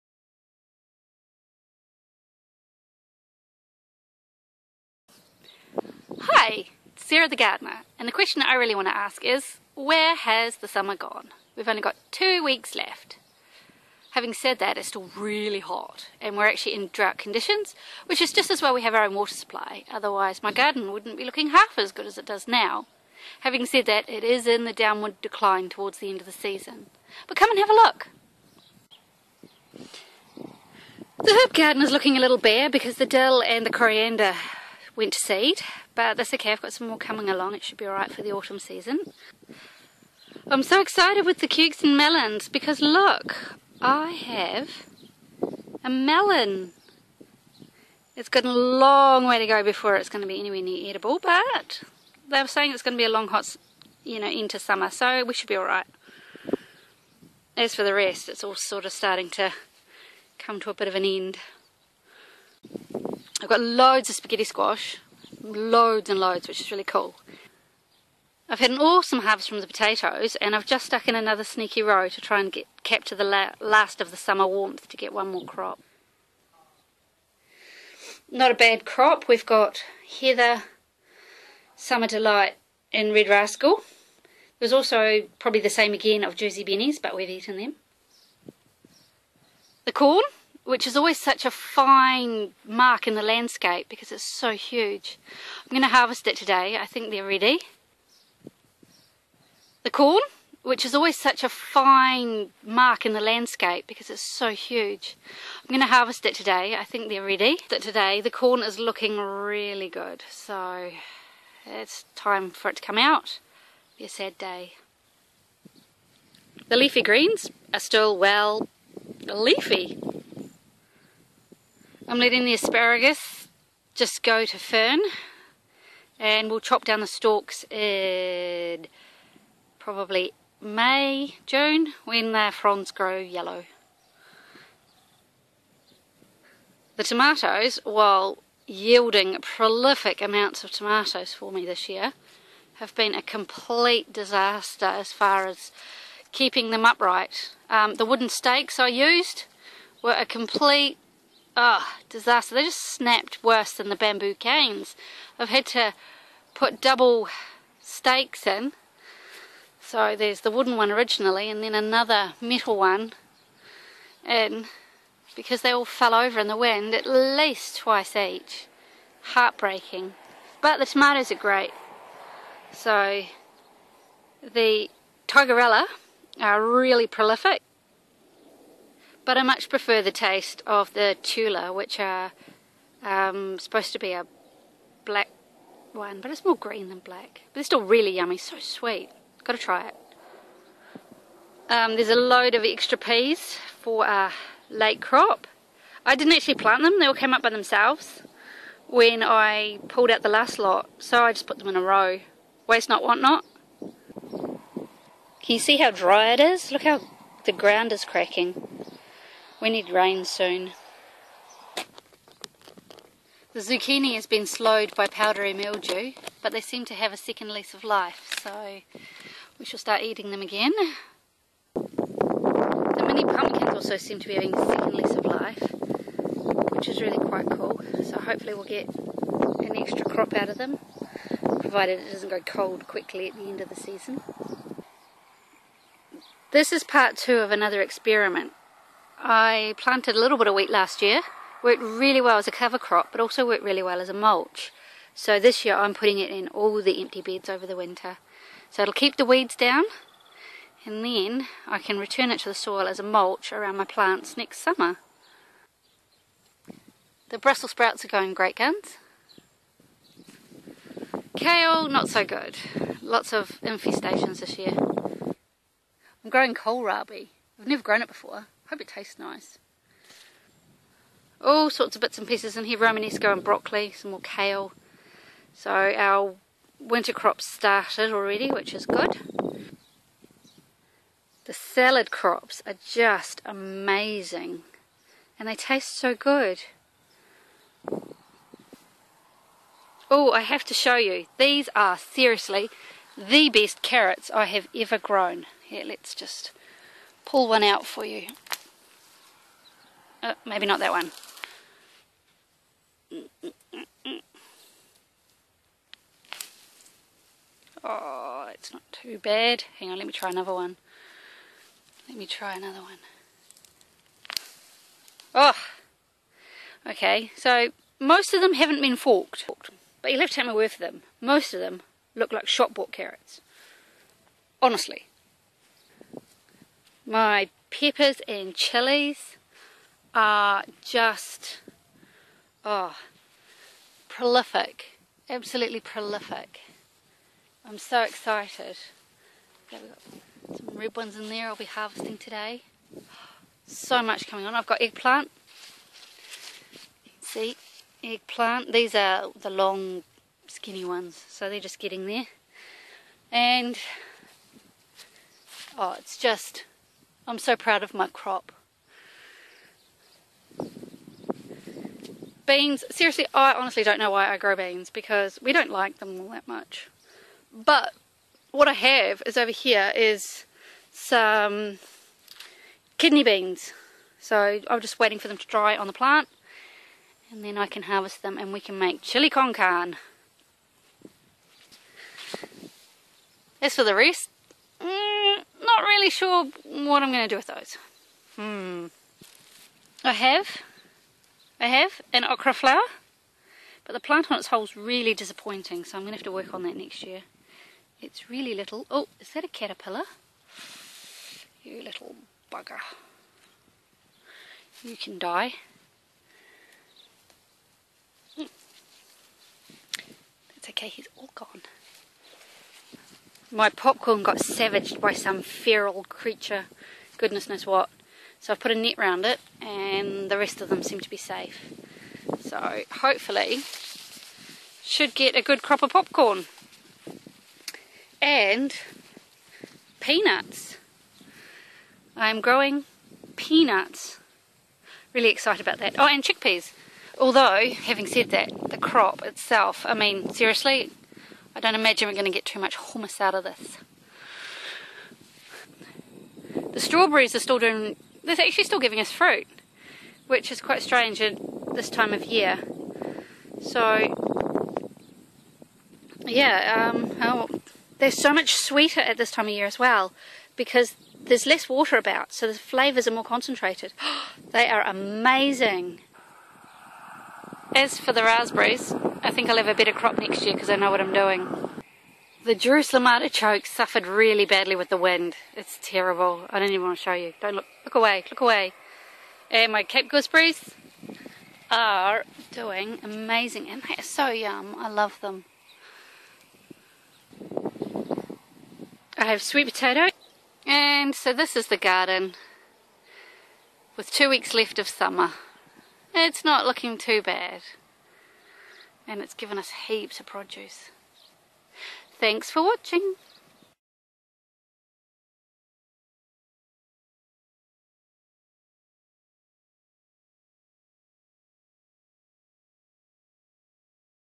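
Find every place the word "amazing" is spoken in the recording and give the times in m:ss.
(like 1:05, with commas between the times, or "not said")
4:43, 7:44, 8:03.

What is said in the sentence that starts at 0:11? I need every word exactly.
We've only got two weeks left.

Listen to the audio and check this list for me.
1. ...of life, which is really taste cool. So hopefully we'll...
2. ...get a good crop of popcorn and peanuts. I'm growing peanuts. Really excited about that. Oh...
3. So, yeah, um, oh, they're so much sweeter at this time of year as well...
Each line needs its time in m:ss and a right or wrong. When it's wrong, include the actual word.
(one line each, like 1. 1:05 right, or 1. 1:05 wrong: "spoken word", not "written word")
1. 3:45 wrong: "quite", not "taste"
2. 7:05 right
3. 7:33 right.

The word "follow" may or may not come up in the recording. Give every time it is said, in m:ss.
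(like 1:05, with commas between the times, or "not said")
not said.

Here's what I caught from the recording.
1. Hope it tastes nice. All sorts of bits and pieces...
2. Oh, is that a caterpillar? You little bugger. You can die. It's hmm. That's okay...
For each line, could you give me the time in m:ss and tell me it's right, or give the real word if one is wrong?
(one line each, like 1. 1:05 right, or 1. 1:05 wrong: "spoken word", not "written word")
1. 4:28 right
2. 6:38 right.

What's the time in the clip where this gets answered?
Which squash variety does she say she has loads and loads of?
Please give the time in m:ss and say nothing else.
1:04.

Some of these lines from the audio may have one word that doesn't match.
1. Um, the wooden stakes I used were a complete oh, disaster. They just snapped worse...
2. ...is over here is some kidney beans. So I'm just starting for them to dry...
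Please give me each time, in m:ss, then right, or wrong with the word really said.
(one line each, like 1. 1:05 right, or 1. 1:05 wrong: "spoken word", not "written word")
1. 2:27 right
2. 6:09 wrong: "waiting", not "starting".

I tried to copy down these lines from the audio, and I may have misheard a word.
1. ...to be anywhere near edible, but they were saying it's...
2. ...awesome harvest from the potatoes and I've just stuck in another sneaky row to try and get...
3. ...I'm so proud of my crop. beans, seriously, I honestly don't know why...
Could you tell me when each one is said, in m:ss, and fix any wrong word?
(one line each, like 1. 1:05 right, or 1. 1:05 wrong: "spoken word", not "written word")
1. 0:50 right
2. 1:08 right
3. 5:57 right.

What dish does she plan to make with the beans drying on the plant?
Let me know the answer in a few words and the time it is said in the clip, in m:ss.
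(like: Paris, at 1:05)
Chili con carne, at 6:19.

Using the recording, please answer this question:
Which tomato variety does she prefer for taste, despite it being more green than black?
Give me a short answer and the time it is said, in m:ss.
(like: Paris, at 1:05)
Tula, at 3:01.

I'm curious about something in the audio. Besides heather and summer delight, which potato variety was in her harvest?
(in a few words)
Red Rascal.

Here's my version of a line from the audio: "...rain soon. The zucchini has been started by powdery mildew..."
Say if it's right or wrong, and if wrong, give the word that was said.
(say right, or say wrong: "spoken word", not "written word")
wrong: "slowed", not "started".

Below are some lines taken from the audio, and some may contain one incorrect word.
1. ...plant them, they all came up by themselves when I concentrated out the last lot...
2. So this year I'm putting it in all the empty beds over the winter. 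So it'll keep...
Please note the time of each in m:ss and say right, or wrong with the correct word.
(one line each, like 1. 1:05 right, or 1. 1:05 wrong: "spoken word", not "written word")
1. 3:16 wrong: "pulled", not "concentrated"
2. 4:05 right.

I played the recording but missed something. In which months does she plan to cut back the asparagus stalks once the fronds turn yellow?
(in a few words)
May, June.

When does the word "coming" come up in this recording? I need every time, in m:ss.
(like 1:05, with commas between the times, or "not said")
0:36, 5:44.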